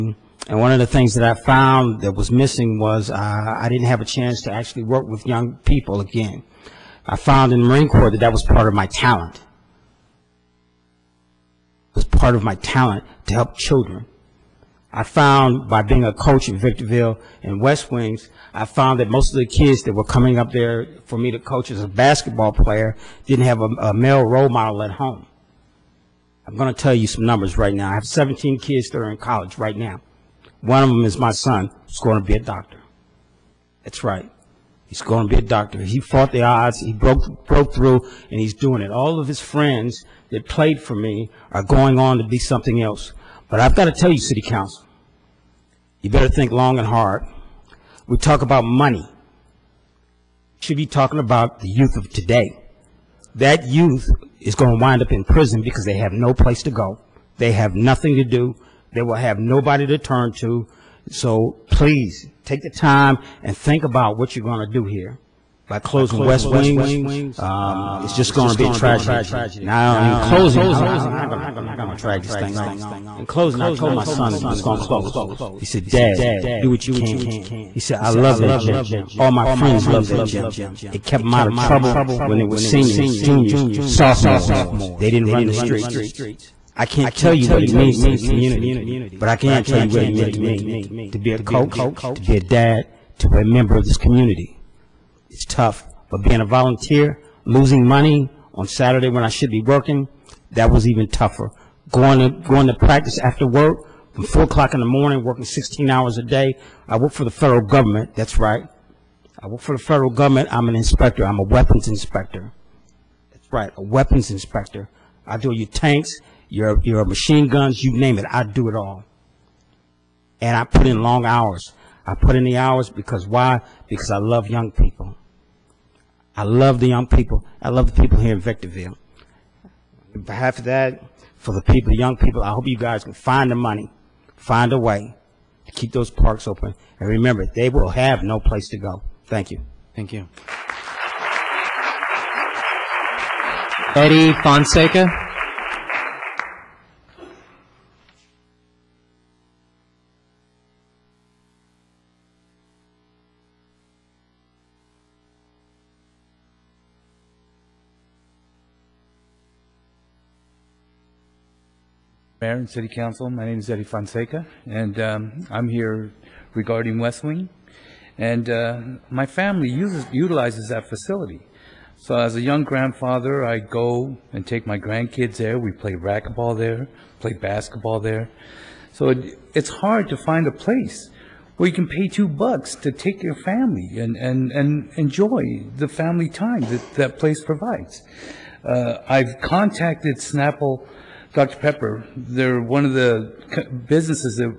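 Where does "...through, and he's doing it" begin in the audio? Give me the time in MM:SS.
00:37.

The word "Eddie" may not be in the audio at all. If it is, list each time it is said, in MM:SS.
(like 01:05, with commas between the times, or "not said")
02:23, 02:43.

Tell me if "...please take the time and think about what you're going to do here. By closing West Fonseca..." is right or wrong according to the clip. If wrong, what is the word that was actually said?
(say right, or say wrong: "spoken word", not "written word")
wrong: "Wings", not "Fonseca".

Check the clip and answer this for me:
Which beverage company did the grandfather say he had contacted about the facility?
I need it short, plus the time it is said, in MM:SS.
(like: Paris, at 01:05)
Snapple Dr. Pepper, at 03:10.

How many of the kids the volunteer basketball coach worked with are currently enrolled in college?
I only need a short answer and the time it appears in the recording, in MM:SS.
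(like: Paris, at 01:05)
17, at 00:28.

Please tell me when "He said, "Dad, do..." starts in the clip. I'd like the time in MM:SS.
01:15.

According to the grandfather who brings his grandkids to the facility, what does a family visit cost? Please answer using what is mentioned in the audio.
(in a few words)
two bucks.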